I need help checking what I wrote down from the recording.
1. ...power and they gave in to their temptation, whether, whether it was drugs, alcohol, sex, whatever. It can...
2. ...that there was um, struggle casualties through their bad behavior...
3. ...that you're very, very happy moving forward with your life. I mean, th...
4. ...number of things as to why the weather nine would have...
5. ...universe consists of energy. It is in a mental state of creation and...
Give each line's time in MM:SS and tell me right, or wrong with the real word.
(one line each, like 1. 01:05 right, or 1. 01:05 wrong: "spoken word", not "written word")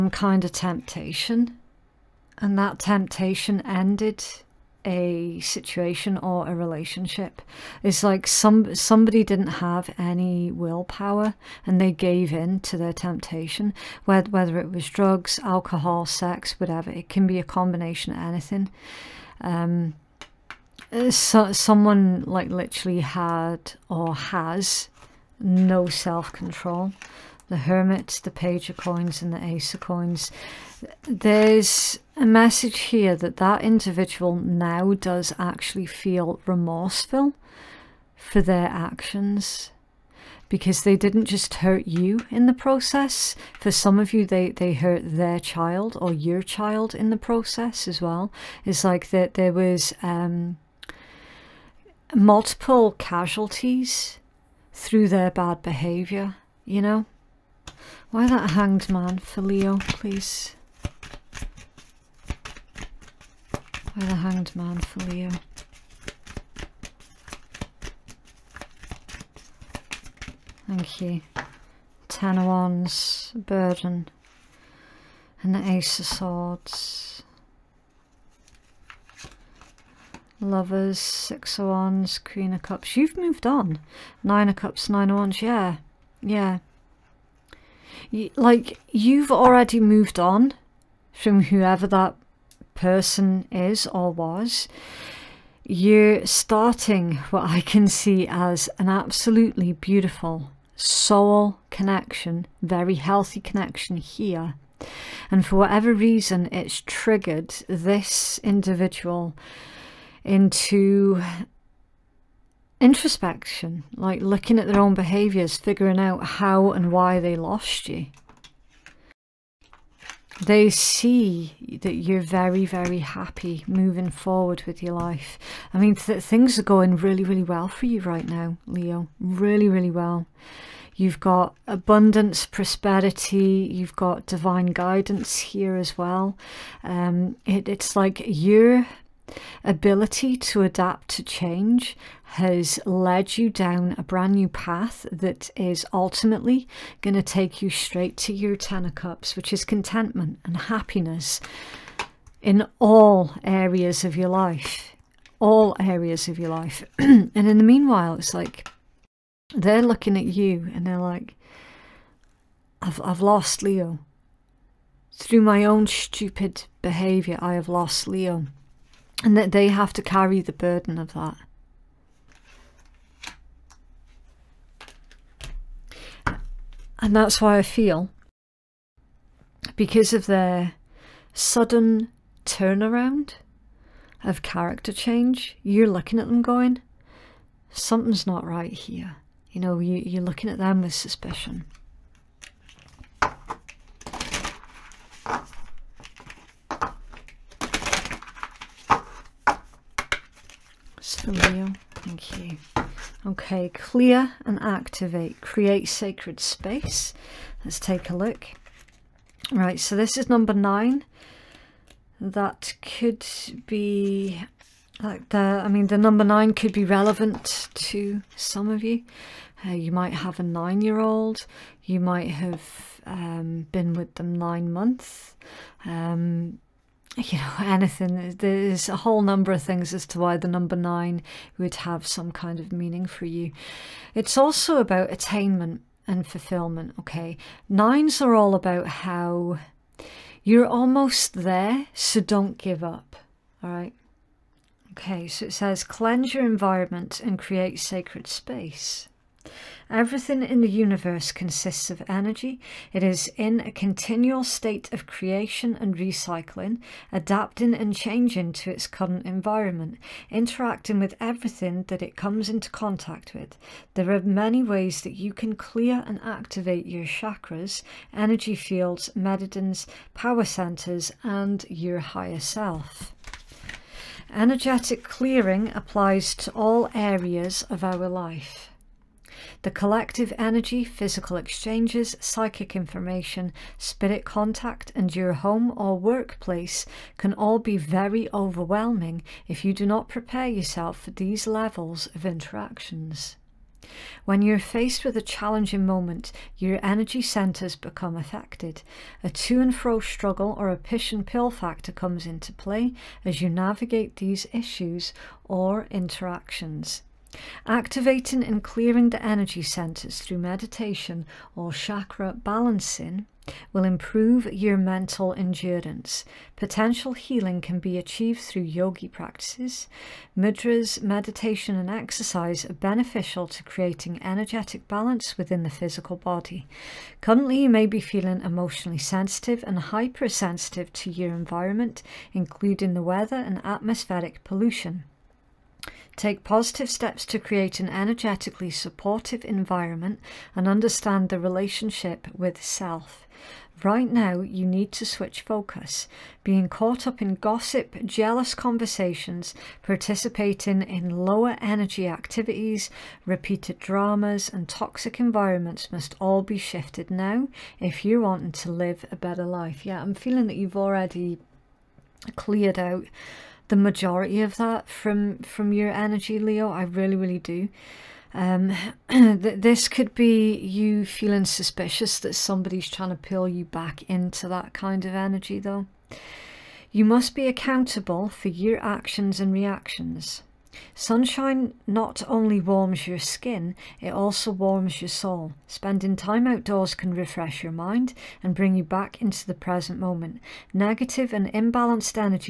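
1. 00:10 wrong: "willpower", not "power"
2. 00:49 wrong: "multiple", not "struggle"
3. 02:01 right
4. 03:49 wrong: "number", not "weather"
5. 04:10 wrong: "continual", not "mental".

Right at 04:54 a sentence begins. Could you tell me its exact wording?
When you're faced with a challenging moment, your energy centers become affected.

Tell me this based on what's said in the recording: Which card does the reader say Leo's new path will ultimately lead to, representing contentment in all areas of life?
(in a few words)
Ten of Cups.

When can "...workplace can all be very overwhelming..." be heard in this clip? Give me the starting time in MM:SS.
04:45.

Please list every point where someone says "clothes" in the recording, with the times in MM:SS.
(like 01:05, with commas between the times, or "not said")
not said.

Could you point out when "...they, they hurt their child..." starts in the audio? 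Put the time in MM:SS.
00:44.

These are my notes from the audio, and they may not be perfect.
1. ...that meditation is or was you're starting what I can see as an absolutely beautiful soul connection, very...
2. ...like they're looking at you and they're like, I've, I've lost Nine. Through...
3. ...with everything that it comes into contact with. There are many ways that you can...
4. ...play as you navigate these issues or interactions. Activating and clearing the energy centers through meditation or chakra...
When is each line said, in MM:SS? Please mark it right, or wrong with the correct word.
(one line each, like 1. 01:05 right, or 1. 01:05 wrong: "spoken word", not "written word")
1. 01:31 wrong: "person", not "meditation"
2. 02:38 wrong: "Leo", not "Nine"
3. 04:20 right
4. 05:02 right.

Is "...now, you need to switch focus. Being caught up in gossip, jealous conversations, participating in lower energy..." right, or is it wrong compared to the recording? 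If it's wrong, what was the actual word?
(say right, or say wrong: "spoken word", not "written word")
right.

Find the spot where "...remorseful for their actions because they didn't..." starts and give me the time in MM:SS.
00:36.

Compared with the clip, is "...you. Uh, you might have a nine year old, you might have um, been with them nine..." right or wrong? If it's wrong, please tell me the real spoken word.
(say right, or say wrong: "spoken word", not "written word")
right.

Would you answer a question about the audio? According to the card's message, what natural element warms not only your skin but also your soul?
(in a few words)
Sunshine.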